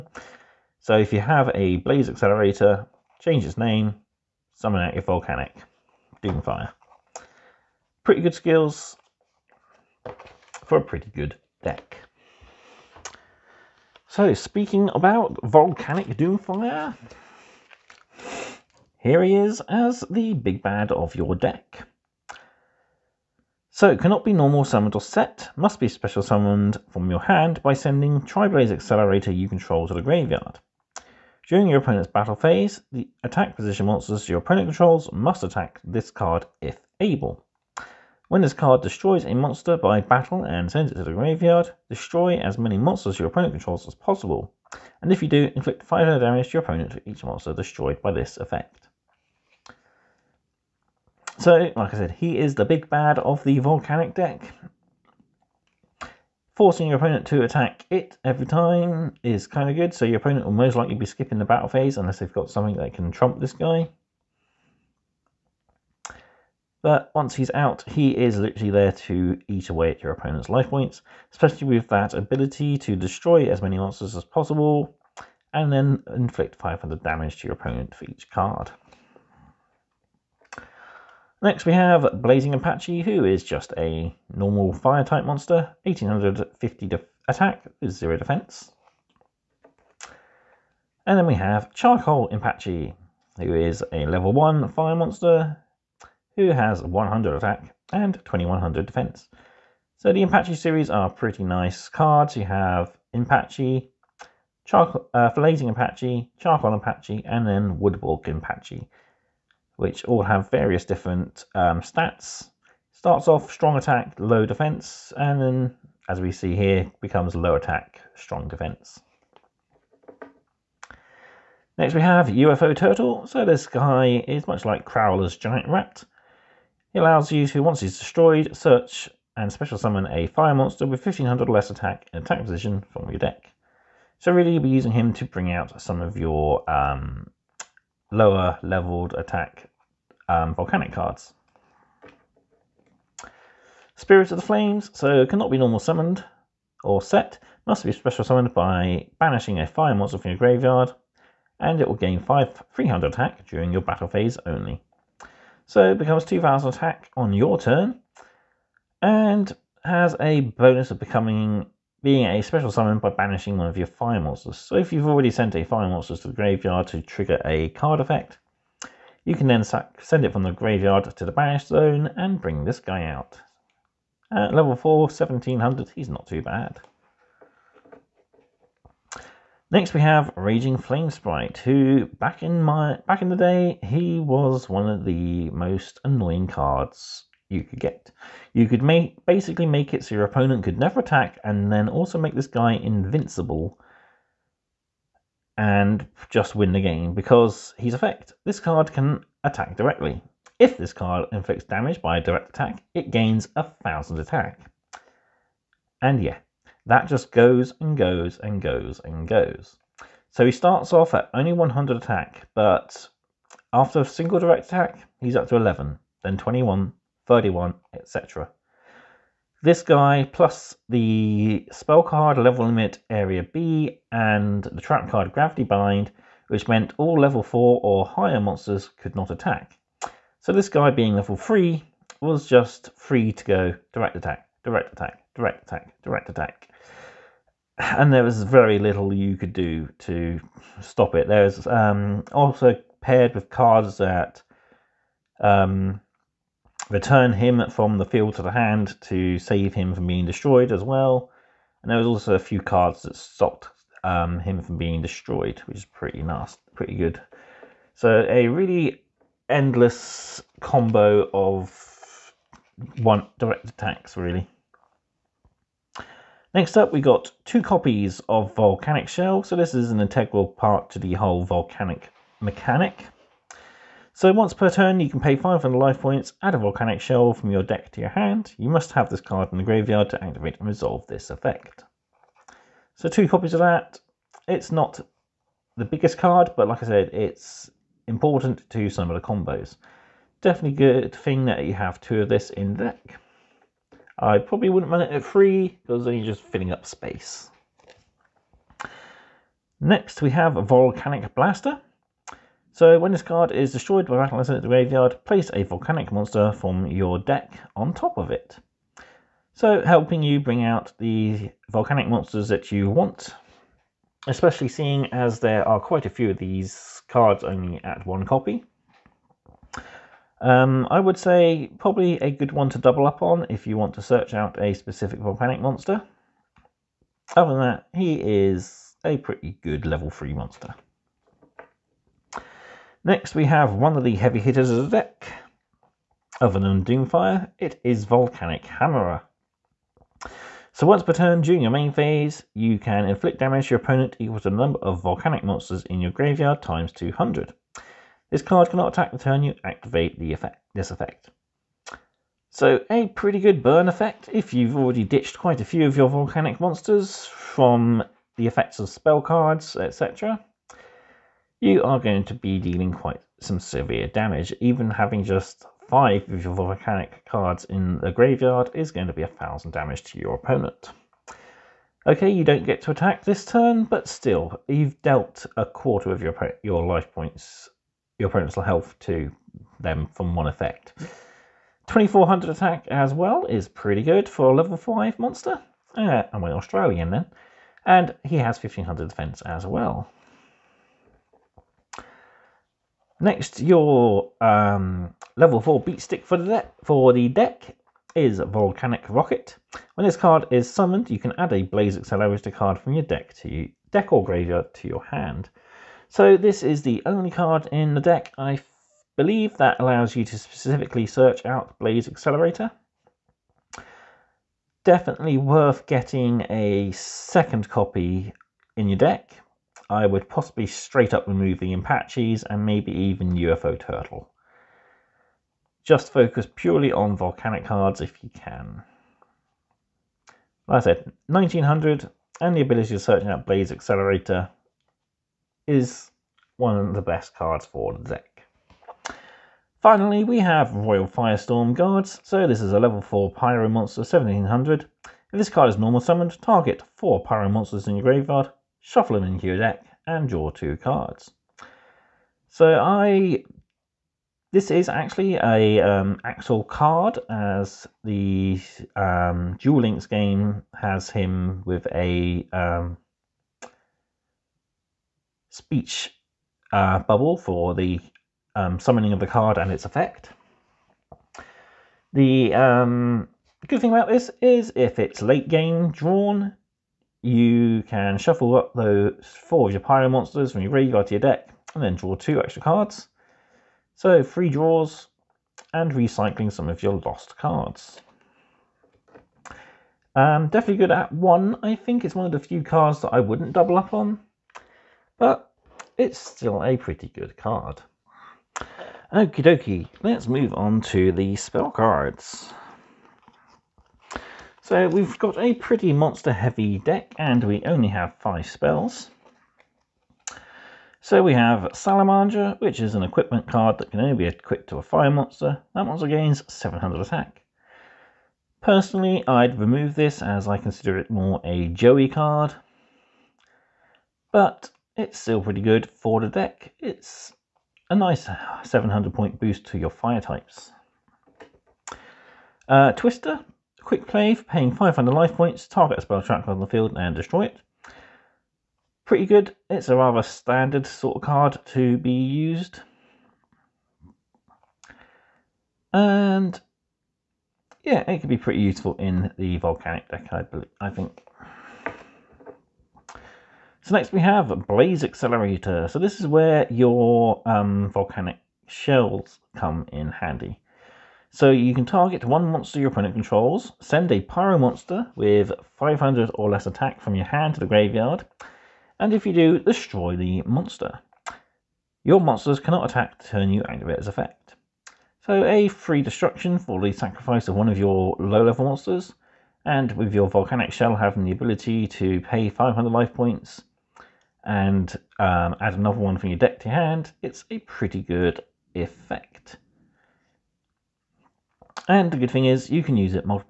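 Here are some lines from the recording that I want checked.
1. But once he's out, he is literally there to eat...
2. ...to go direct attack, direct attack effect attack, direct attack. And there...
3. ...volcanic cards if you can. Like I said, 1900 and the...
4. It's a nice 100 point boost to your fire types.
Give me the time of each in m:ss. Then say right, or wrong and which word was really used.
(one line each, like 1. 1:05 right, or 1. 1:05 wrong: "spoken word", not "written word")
1. 1:06 right
2. 3:53 wrong: "direct", not "effect"
3. 7:07 right
4. 8:46 wrong: "700", not "100".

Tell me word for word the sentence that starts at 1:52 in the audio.
Starts off strong attack, low defense, and then, as we see here, becomes low attack, strong defense.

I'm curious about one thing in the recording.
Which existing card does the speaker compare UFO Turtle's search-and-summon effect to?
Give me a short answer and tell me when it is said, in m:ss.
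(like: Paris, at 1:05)
Crowler's Giant Rat, at 2:04.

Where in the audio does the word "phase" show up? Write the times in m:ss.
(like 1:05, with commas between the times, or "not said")
0:32, 1:01, 2:34, 5:41.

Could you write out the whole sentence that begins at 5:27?
Other than that, he is a pretty good level 3 monster.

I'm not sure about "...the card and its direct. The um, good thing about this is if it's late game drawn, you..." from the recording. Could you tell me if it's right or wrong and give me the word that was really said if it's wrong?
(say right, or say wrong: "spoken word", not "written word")
wrong: "effect", not "direct".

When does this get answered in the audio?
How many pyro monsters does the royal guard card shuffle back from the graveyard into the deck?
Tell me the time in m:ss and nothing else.
7:26.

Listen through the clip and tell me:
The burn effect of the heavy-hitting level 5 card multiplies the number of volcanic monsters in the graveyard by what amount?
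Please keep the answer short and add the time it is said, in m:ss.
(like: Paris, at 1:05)
200, at 5:46.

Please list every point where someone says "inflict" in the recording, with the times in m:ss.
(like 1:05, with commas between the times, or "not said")
0:45, 1:16, 3:21, 5:43.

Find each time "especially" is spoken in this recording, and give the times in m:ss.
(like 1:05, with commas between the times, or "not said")
1:11, 5:14.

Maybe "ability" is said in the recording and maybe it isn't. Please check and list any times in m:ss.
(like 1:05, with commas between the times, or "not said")
1:12, 7:12, 9:41.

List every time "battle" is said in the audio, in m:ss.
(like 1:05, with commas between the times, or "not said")
0:32, 0:39, 1:01, 2:33, 5:04.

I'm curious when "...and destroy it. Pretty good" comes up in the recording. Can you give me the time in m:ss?
8:56.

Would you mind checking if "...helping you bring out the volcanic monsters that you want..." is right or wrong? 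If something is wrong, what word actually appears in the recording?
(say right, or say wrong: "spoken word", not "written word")
right.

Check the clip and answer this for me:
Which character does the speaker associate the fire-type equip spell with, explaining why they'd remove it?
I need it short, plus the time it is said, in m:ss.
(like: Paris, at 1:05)
Joey, at 8:41.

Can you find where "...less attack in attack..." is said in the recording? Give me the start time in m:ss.
2:11.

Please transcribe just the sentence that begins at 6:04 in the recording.
Even having just five of your volcanic cards in the graveyard is going to be a thousand damage to your opponent.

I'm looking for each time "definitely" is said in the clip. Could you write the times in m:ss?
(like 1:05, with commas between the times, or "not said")
4:50, 6:54, 8:10.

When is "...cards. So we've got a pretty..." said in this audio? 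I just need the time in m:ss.
8:21.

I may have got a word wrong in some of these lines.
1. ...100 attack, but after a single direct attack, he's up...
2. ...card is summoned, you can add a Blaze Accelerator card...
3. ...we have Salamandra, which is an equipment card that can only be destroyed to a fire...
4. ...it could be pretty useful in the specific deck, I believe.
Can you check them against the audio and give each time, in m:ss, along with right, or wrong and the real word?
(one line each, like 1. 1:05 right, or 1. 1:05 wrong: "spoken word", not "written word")
1. 3:31 right
2. 6:40 right
3. 8:31 wrong: "equipped", not "destroyed"
4. 9:08 wrong: "volcanic", not "specific".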